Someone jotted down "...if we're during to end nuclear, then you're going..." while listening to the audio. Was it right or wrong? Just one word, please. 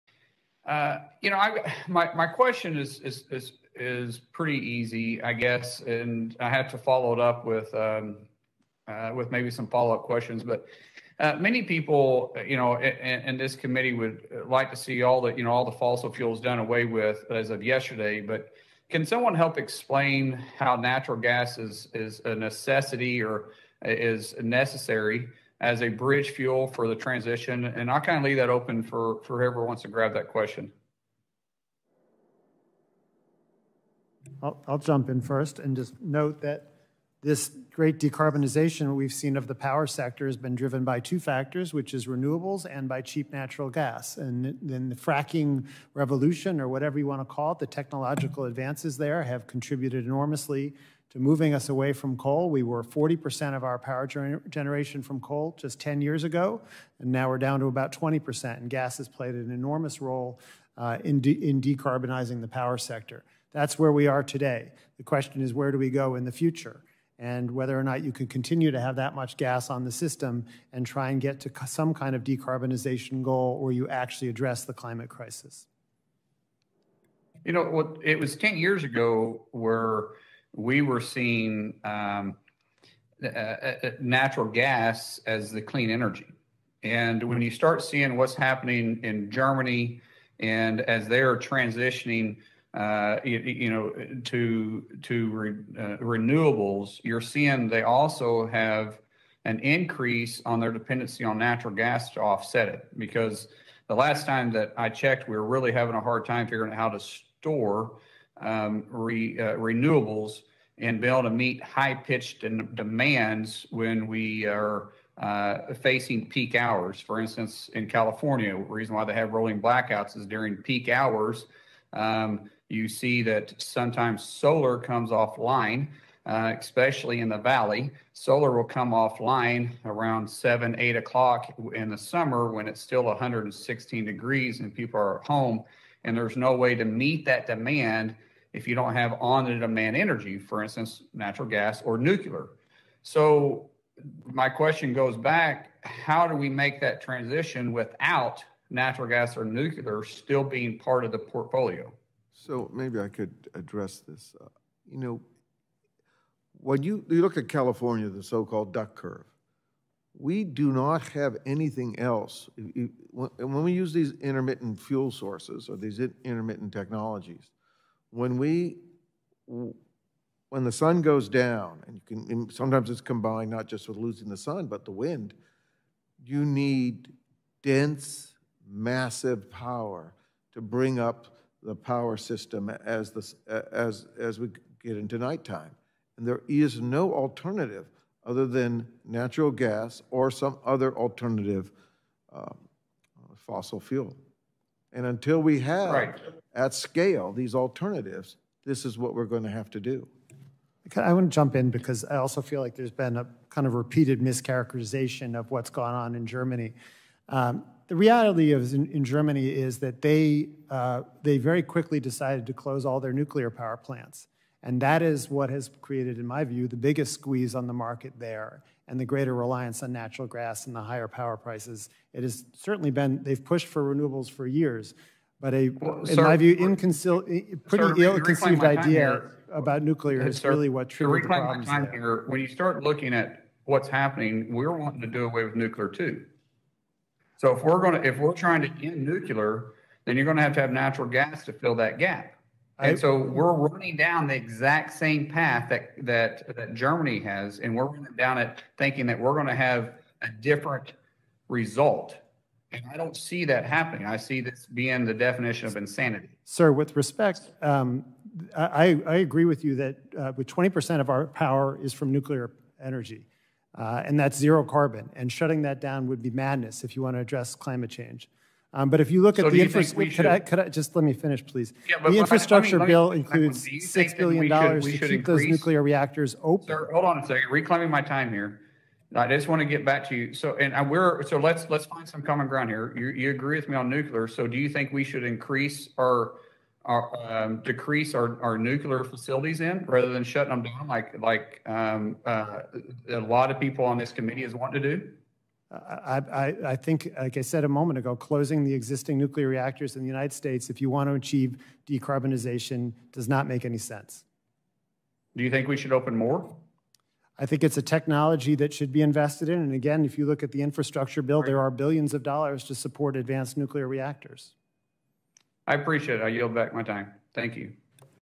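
wrong.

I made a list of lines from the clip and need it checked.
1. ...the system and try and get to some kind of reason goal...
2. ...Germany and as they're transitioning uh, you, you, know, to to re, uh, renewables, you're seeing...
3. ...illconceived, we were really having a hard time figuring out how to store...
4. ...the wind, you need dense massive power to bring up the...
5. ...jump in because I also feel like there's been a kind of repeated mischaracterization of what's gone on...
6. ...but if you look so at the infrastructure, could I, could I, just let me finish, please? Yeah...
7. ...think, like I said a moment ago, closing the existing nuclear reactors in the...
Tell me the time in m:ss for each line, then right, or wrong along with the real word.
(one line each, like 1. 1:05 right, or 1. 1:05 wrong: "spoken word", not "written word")
1. 1:09 wrong: "decarbonization", not "reason"
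2. 1:29 right
3. 1:44 wrong: "checked", not "illconceived"
4. 2:54 right
5. 3:21 right
6. 4:28 right
7. 4:56 right.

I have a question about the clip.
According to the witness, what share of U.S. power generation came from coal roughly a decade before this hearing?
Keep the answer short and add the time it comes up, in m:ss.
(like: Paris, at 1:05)
40%, at 0:52.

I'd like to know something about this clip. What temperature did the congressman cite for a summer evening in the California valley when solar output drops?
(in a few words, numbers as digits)
116 degrees.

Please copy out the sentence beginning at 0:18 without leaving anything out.
But can someone help explain how natural gas is is a necessity or is necessary?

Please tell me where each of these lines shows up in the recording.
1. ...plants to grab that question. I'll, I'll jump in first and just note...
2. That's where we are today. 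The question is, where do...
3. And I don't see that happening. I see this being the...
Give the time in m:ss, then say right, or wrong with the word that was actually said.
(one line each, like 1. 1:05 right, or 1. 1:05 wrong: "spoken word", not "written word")
1. 0:29 wrong: "wants", not "plants"
2. 1:03 right
3. 4:12 right.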